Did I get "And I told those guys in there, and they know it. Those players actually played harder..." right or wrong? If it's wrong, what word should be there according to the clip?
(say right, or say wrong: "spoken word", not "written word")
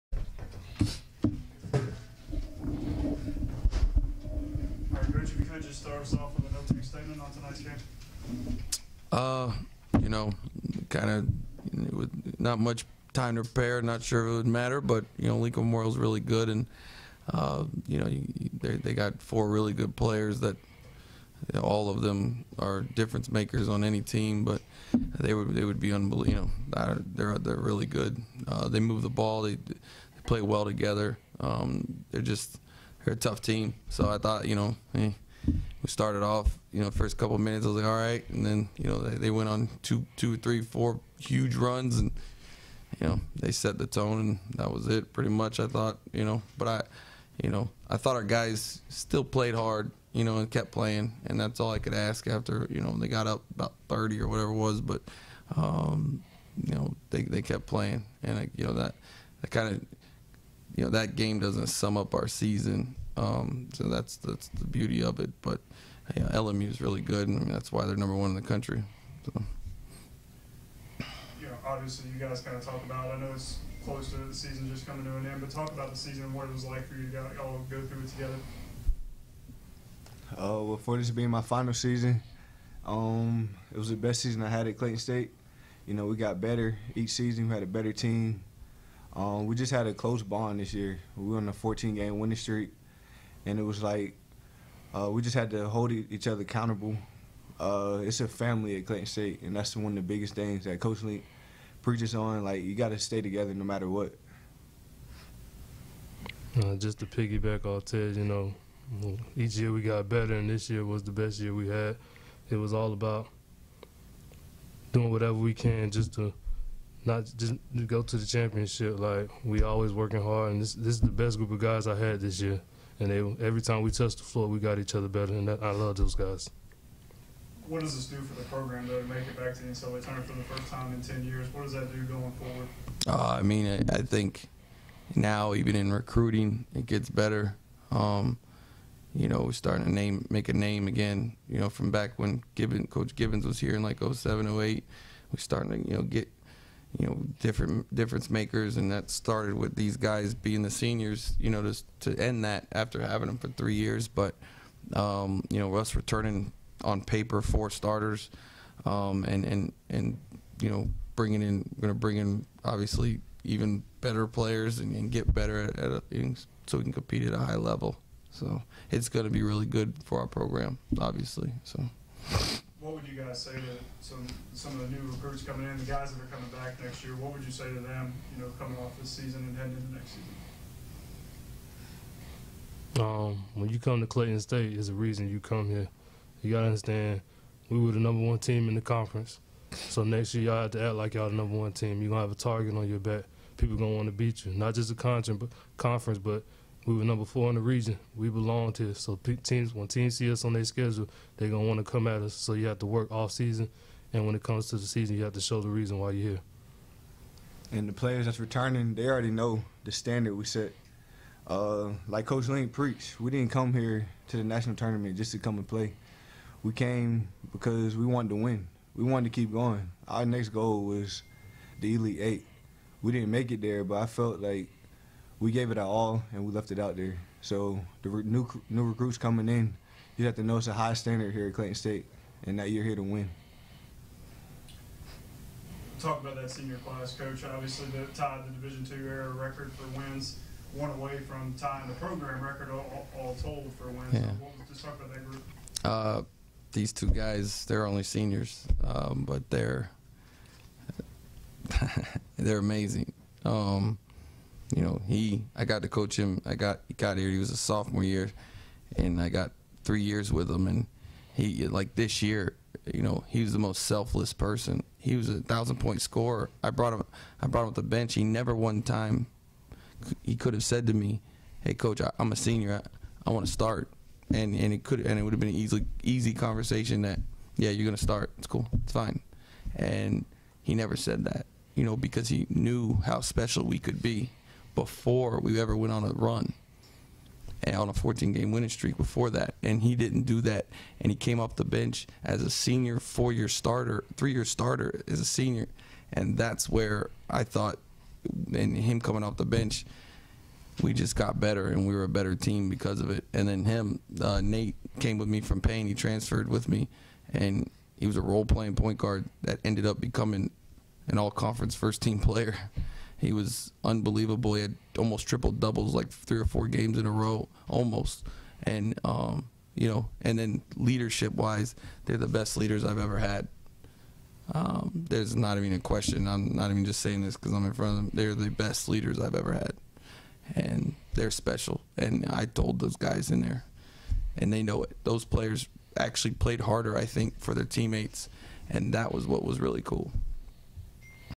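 right.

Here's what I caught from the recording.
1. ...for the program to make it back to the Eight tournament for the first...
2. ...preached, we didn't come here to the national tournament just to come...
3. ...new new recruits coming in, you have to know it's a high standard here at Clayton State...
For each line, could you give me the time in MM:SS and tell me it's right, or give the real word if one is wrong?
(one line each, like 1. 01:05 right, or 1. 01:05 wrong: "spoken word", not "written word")
1. 02:08 wrong: "NCAA", not "Eight"
2. 03:32 right
3. 03:48 right.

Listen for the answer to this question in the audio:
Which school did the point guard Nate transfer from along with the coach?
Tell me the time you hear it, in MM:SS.
05:05.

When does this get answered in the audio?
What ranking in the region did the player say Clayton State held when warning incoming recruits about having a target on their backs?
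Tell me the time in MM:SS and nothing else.
03:17.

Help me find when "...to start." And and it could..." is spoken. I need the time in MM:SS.
04:33.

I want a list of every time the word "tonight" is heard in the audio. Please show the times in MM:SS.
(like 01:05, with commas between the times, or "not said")
00:07.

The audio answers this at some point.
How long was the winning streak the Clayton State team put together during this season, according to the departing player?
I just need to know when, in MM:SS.
01:31.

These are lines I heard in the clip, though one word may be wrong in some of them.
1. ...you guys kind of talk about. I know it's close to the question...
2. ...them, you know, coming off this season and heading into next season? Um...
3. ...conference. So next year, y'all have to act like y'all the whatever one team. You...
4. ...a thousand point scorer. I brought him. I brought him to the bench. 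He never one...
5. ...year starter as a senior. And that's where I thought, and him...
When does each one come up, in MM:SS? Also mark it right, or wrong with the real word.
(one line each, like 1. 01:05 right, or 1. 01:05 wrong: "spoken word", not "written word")
1. 01:12 wrong: "season", not "question"
2. 02:57 right
3. 03:08 wrong: "number", not "whatever"
4. 04:25 right
5. 04:54 right.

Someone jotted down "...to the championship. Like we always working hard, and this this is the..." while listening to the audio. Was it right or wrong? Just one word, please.
right.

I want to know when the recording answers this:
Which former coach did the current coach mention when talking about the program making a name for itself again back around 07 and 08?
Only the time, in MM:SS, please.
02:22.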